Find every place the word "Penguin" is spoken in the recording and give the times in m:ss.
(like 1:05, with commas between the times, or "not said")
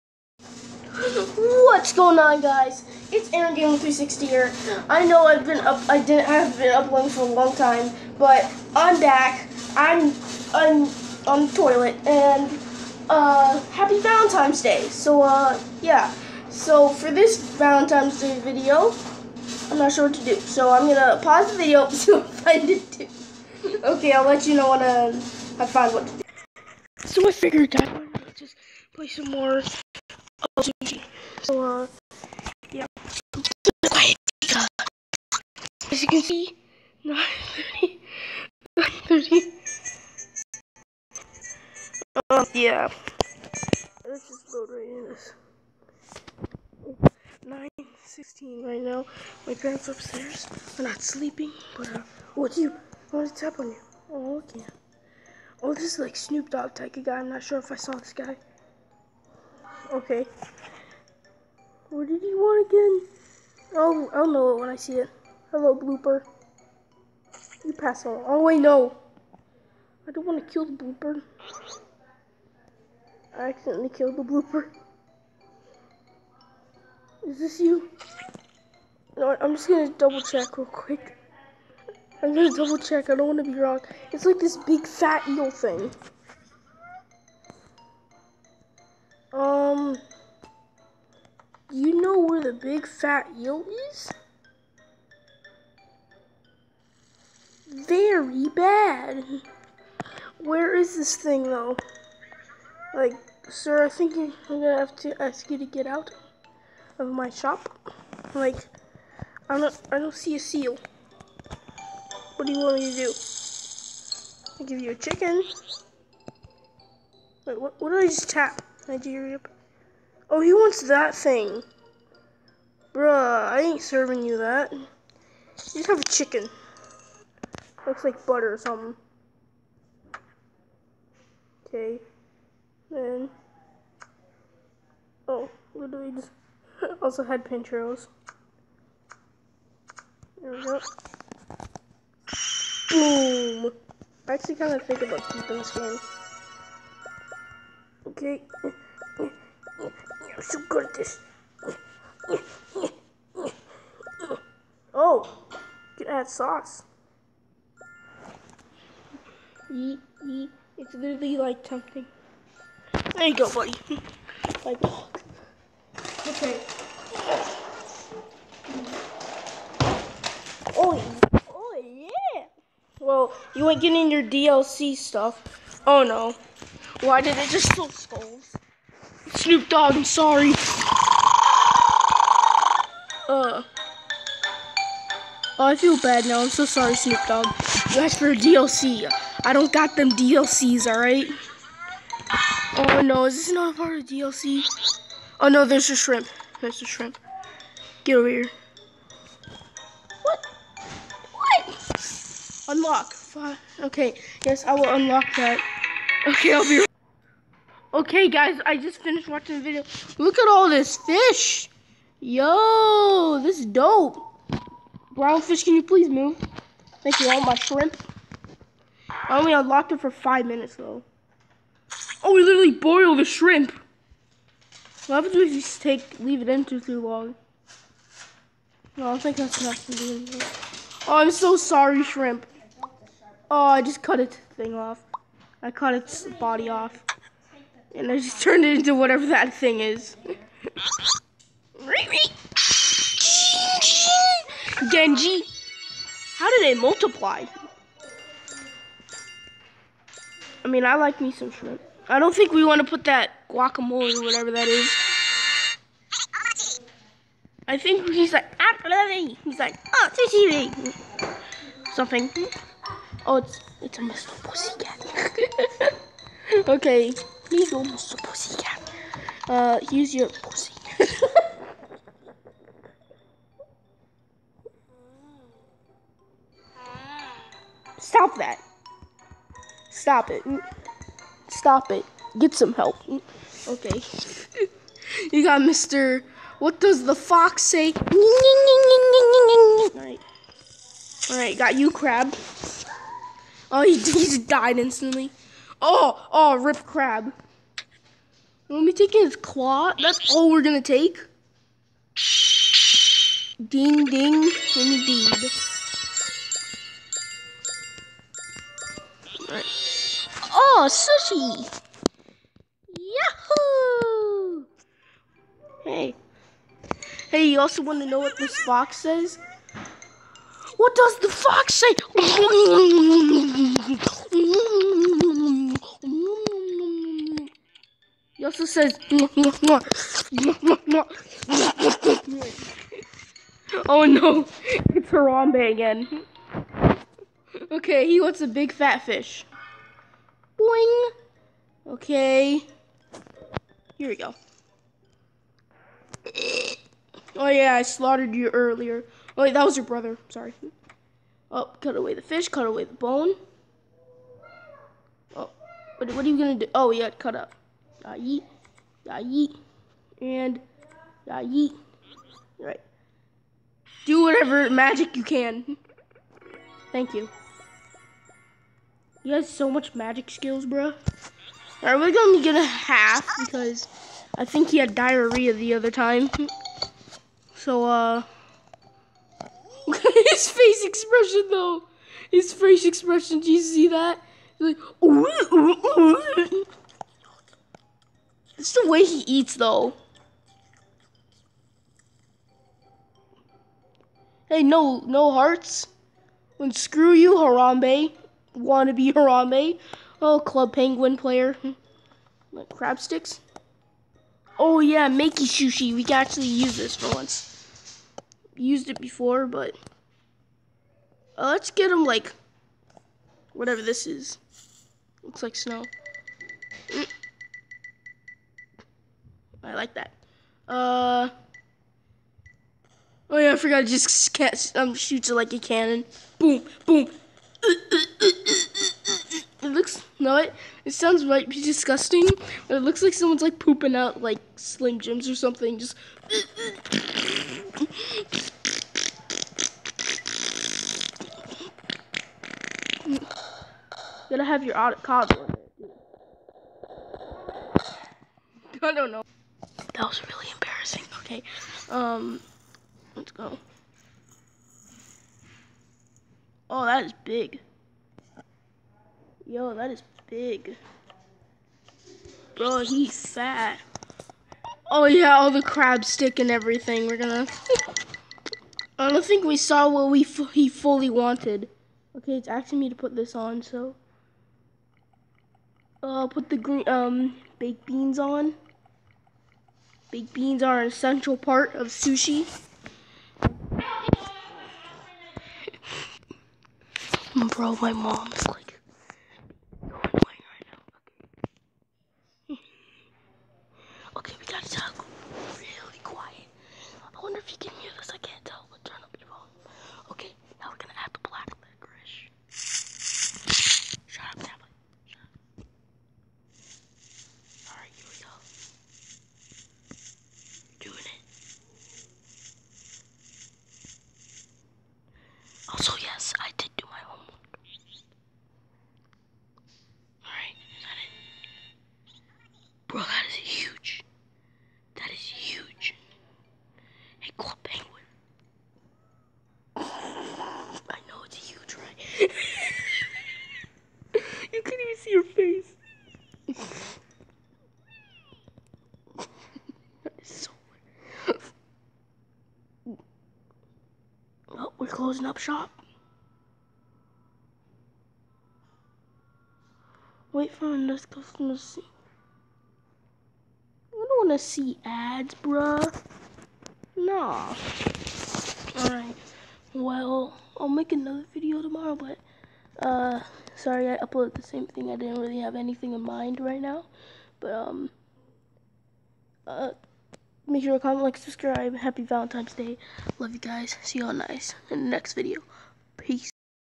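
6:40.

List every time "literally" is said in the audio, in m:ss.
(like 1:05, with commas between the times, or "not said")
2:15, 2:40, 3:42.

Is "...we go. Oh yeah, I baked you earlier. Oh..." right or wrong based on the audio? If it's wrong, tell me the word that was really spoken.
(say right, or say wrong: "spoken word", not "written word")
wrong: "slaughtered", not "baked".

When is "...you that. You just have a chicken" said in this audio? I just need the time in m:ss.
2:04.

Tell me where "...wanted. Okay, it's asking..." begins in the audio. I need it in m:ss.
7:51.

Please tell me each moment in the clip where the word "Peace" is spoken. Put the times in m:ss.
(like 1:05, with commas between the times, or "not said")
9:35.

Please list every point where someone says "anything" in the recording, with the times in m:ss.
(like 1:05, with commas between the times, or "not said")
3:50, 9:25.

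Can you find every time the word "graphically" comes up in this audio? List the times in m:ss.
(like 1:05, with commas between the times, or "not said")
not said.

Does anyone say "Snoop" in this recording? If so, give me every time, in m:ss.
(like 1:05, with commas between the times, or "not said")
0:56, 2:59, 3:06.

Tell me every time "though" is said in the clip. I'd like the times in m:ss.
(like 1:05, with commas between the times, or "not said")
1:41, 3:40, 6:21, 6:29.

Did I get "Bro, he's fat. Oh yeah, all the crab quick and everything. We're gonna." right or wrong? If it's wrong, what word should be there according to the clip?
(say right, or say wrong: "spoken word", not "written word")
wrong: "stick", not "quick".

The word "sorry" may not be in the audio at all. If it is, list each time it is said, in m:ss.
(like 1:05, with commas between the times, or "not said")
3:00, 3:06, 3:51, 5:50, 9:23.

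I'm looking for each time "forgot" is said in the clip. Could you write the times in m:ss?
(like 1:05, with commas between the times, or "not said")
7:03.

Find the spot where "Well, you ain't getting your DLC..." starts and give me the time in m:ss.
2:52.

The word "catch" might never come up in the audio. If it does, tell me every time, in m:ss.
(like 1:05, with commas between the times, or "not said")
7:04.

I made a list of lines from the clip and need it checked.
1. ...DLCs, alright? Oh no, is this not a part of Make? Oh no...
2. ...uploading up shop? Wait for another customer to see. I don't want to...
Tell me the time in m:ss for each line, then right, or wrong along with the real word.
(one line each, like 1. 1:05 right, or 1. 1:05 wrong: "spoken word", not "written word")
1. 3:10 wrong: "DLC", not "Make"
2. 9:05 wrong: "closing", not "uploading".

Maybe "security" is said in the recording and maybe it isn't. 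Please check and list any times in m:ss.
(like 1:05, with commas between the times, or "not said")
not said.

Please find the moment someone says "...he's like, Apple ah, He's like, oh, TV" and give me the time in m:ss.
4:18.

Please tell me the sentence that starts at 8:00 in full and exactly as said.
Baked beans are an essential part of sushi.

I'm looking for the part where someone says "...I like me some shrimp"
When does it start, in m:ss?
4:10.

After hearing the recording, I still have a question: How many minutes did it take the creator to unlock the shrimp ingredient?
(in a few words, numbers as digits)
5.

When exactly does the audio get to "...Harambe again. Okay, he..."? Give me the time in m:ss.
5:35.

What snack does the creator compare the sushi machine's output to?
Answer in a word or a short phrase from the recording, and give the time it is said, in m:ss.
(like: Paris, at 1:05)
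Slim Jims, at 7:14.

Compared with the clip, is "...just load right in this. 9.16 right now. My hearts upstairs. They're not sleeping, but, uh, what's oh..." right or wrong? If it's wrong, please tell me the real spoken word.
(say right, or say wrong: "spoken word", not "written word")
wrong: "parents", not "hearts".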